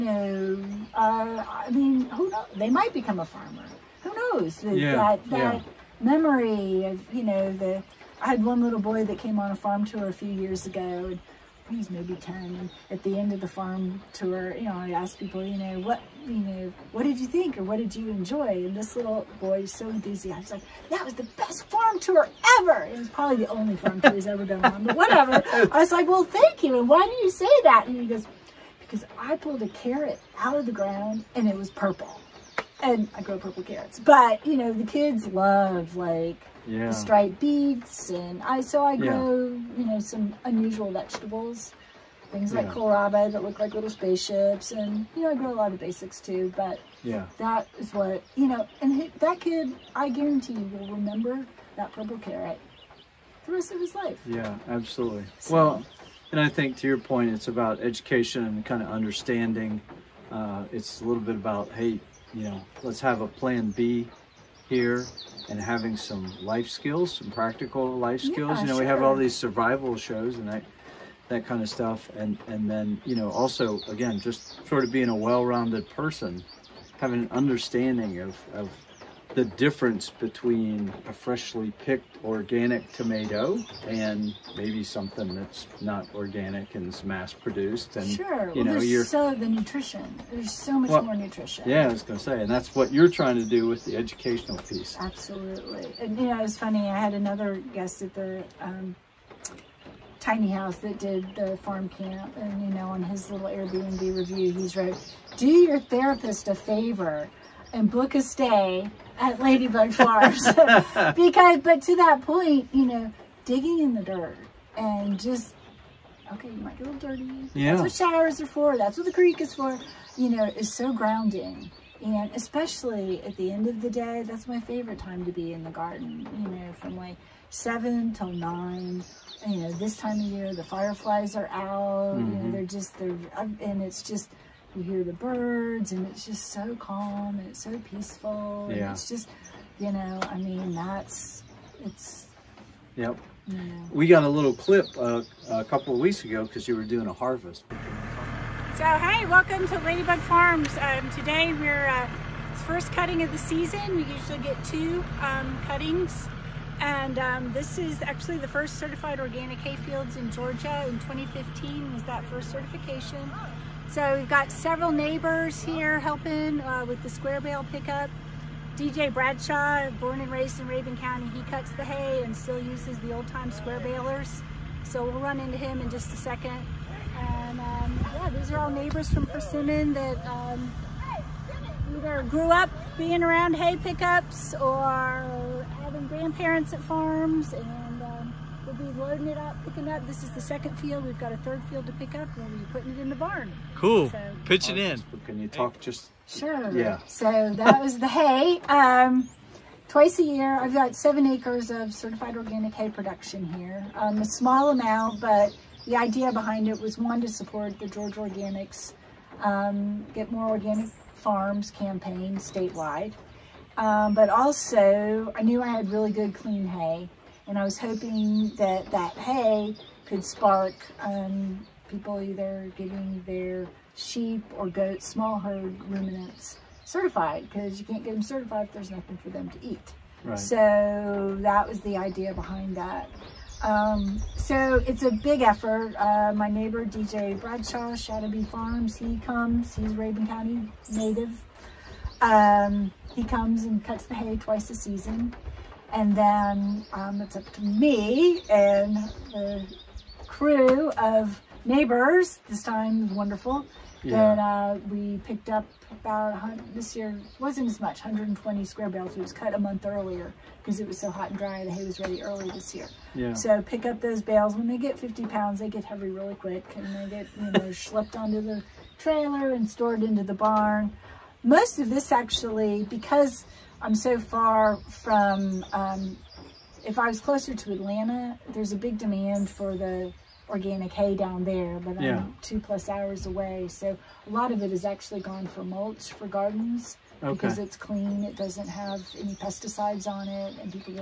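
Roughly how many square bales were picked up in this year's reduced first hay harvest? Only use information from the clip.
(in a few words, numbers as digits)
120.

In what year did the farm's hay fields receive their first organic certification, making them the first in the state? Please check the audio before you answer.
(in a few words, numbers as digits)
2015.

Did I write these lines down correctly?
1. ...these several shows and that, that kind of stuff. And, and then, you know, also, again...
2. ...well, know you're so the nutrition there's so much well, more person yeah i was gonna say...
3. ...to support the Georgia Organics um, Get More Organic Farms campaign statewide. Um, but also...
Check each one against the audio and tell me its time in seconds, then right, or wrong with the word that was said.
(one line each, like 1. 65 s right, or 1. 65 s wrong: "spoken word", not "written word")
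1. 69 s wrong: "survival", not "several"
2. 88 s wrong: "nutrition", not "person"
3. 207 s right.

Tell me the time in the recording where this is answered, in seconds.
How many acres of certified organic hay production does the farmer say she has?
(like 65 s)
200 s.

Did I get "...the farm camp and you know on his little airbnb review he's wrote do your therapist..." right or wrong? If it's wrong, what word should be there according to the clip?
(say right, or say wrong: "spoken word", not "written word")
right.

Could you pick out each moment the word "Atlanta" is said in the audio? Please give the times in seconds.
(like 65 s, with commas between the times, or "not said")
277 s.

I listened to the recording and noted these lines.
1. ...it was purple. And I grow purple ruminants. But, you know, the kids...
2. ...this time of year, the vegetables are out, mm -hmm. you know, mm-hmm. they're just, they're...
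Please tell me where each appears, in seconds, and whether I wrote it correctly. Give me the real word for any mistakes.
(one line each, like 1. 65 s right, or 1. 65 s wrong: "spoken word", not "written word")
1. 31 s wrong: "carrots", not "ruminants"
2. 129 s wrong: "fireflies", not "vegetables".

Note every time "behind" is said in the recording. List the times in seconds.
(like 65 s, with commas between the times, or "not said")
206 s, 232 s.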